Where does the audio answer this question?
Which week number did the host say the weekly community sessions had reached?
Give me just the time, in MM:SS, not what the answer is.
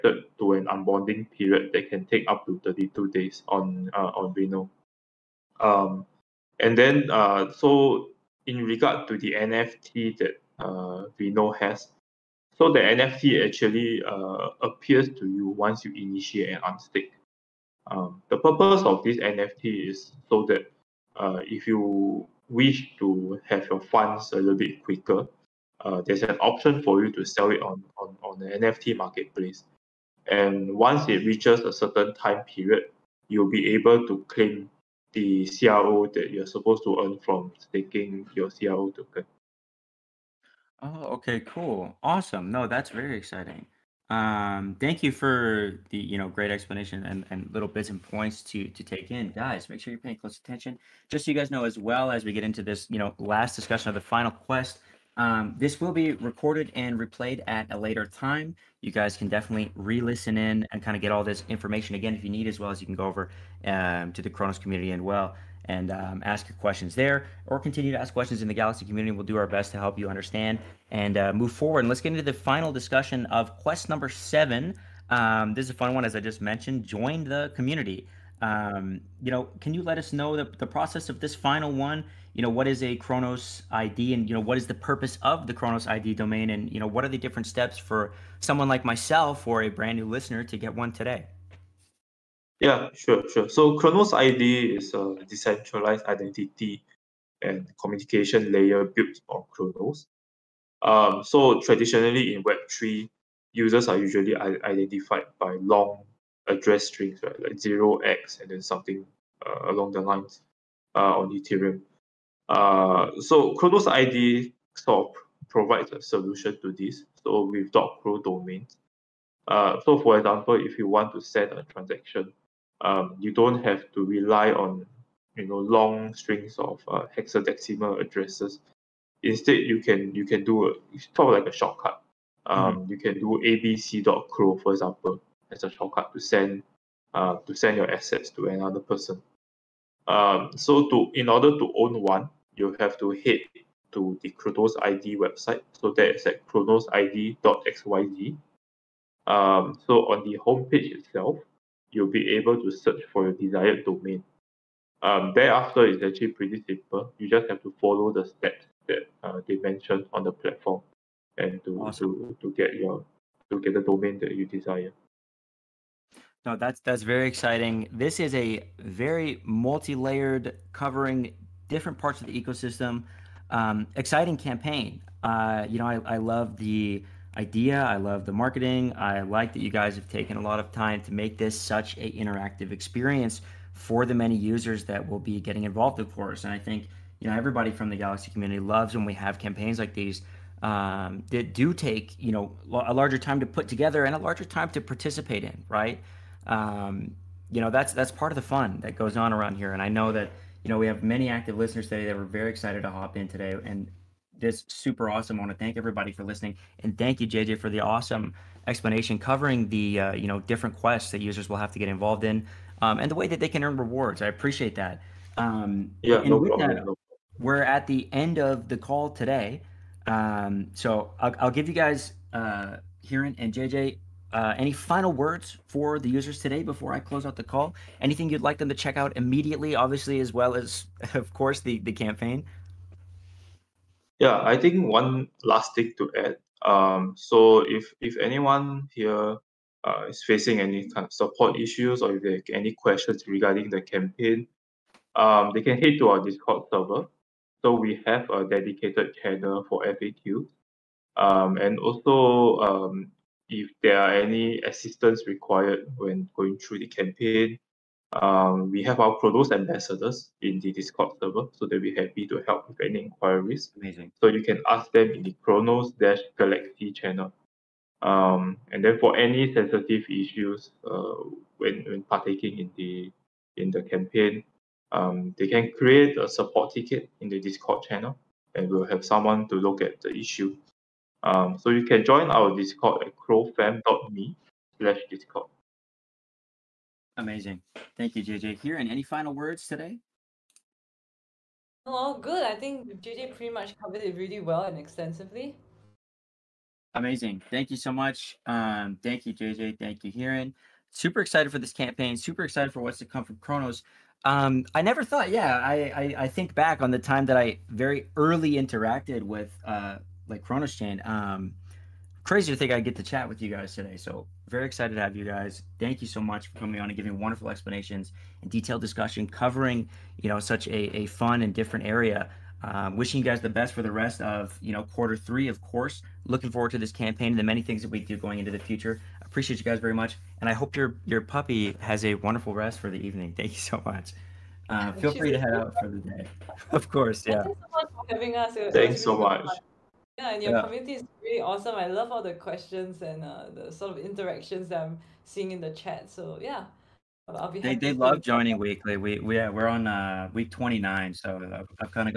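05:50.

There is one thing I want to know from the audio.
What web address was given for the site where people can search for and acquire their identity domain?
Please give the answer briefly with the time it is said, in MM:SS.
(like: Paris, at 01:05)
cronosid.xyz, at 02:26.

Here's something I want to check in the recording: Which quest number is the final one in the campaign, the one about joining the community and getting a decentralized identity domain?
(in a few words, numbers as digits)
7.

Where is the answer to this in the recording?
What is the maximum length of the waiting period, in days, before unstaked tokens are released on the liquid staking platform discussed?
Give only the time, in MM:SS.
00:02.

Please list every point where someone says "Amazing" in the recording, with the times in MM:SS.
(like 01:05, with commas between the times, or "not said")
04:23, 04:47, 04:56.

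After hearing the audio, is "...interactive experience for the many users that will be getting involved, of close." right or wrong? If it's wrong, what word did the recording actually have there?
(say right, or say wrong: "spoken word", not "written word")
wrong: "course", not "close".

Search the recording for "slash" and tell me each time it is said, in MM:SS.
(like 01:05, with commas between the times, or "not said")
04:44.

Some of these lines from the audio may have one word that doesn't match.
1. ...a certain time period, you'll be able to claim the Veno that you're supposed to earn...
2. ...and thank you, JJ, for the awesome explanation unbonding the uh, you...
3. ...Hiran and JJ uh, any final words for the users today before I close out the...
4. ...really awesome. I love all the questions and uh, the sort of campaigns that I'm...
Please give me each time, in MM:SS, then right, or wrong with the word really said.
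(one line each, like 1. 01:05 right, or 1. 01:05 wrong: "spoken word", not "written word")
1. 00:31 wrong: "CRO", not "Veno"
2. 03:26 wrong: "covering", not "unbonding"
3. 03:43 right
4. 05:41 wrong: "interactions", not "campaigns".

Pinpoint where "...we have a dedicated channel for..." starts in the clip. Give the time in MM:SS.
04:07.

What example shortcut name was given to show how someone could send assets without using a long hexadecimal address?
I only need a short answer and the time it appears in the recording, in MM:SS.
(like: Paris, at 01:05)
abc.cro, at 02:13.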